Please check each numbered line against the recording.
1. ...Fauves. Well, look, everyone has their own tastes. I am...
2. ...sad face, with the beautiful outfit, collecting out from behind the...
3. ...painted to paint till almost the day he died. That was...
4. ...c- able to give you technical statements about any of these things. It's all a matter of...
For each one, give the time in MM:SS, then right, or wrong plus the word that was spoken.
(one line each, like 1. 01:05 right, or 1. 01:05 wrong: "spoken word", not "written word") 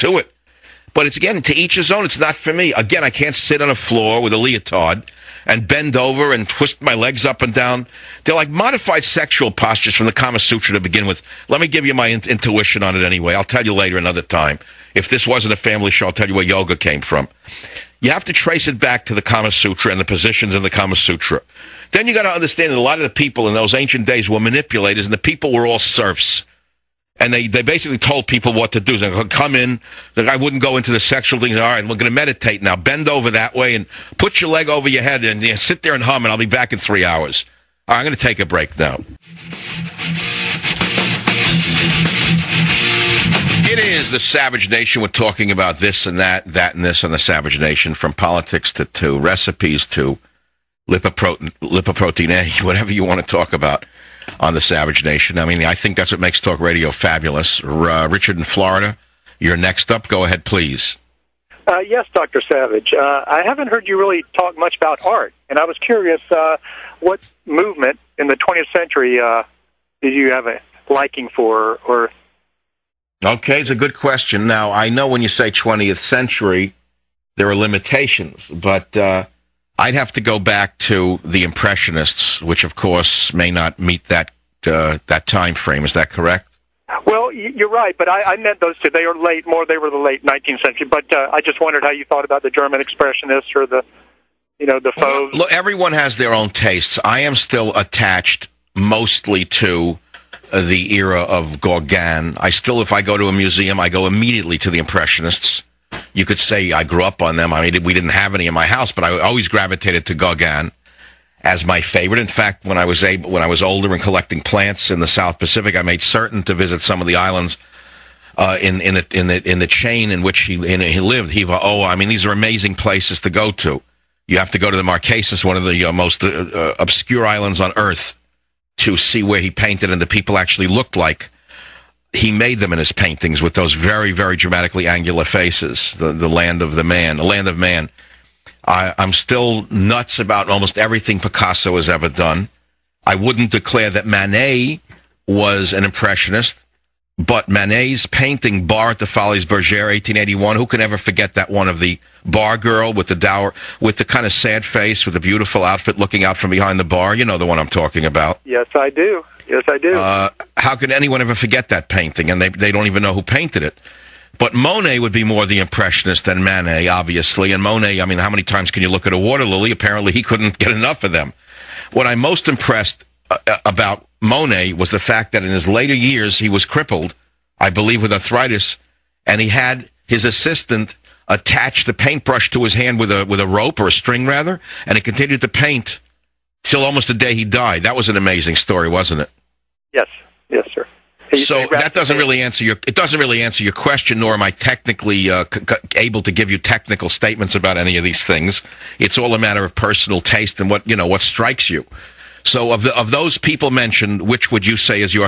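1. 01:34 right
2. 02:34 wrong: "looking", not "collecting"
3. 03:05 wrong: "continued", not "painted"
4. 03:15 right.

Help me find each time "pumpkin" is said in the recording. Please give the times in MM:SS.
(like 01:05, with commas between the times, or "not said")
not said.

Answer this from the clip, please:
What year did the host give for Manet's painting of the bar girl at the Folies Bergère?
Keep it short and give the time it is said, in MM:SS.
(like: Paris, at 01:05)
1881, at 02:29.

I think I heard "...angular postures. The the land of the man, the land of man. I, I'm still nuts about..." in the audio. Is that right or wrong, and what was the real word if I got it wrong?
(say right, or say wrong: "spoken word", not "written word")
wrong: "faces", not "postures".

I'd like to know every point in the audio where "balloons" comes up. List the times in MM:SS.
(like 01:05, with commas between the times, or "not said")
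not said.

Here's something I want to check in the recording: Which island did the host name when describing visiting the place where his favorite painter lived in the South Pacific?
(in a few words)
Hiva Oa.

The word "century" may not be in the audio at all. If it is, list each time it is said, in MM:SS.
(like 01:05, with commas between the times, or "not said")
01:08, 01:15, 01:30.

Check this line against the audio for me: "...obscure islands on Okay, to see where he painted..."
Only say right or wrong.
wrong.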